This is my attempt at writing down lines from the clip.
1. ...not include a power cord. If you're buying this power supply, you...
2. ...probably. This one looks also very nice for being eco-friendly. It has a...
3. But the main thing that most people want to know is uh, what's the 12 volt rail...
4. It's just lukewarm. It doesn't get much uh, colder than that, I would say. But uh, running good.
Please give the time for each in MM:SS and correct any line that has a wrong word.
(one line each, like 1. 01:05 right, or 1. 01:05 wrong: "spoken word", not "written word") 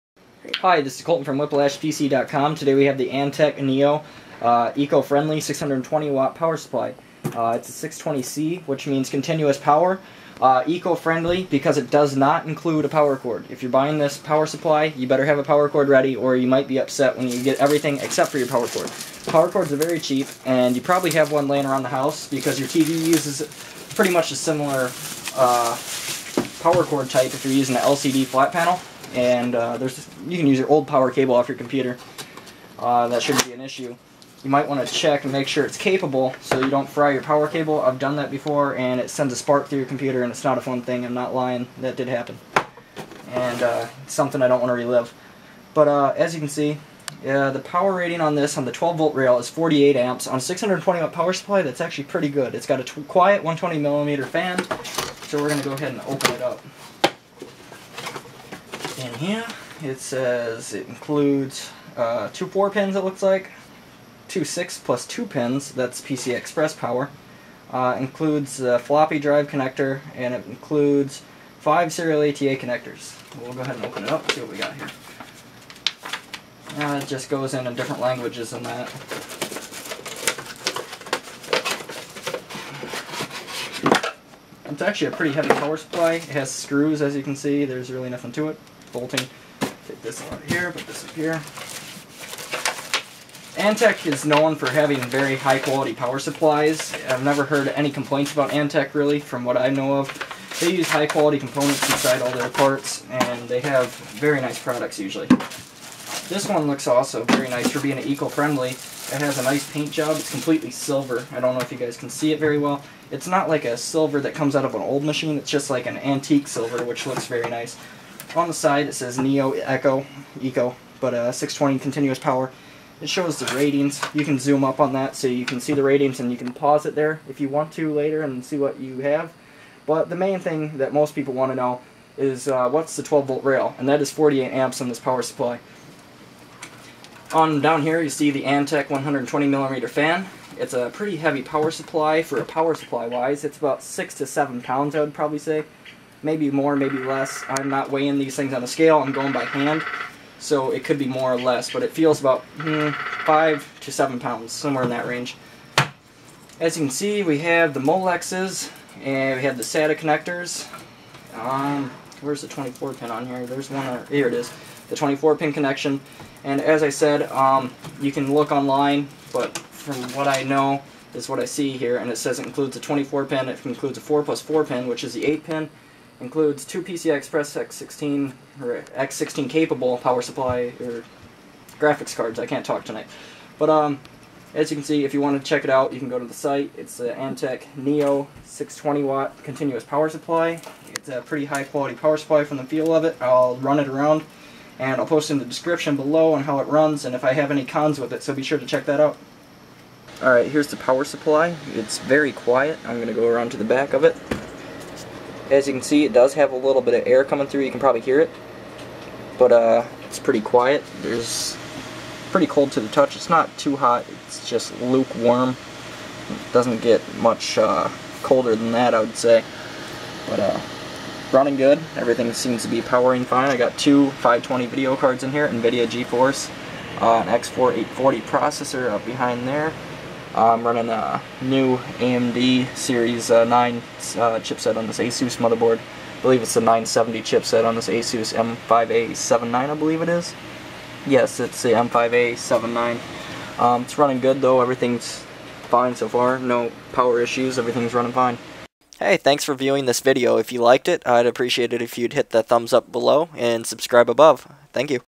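1. 00:12 right
2. 01:44 wrong: "usually", not "probably"
3. 02:09 right
4. 03:34 right.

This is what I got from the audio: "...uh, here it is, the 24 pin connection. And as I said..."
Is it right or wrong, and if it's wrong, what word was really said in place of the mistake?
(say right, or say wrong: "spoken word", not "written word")
right.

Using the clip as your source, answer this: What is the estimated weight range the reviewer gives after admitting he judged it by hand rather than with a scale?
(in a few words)
5 to 7 pounds.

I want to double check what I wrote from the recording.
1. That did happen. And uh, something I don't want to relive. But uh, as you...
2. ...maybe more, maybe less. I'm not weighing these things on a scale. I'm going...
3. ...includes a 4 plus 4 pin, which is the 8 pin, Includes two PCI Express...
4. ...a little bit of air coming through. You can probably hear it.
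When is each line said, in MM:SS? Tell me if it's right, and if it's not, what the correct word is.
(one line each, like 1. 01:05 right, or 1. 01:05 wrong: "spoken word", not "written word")
1. 00:41 right
2. 02:26 right
3. 02:53 right
4. 03:26 right.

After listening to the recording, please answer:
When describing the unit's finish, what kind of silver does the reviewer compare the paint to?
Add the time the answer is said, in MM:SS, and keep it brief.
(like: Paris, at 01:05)
antique silver, at 01:55.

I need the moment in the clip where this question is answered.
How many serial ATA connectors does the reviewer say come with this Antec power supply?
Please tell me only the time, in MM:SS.
01:11.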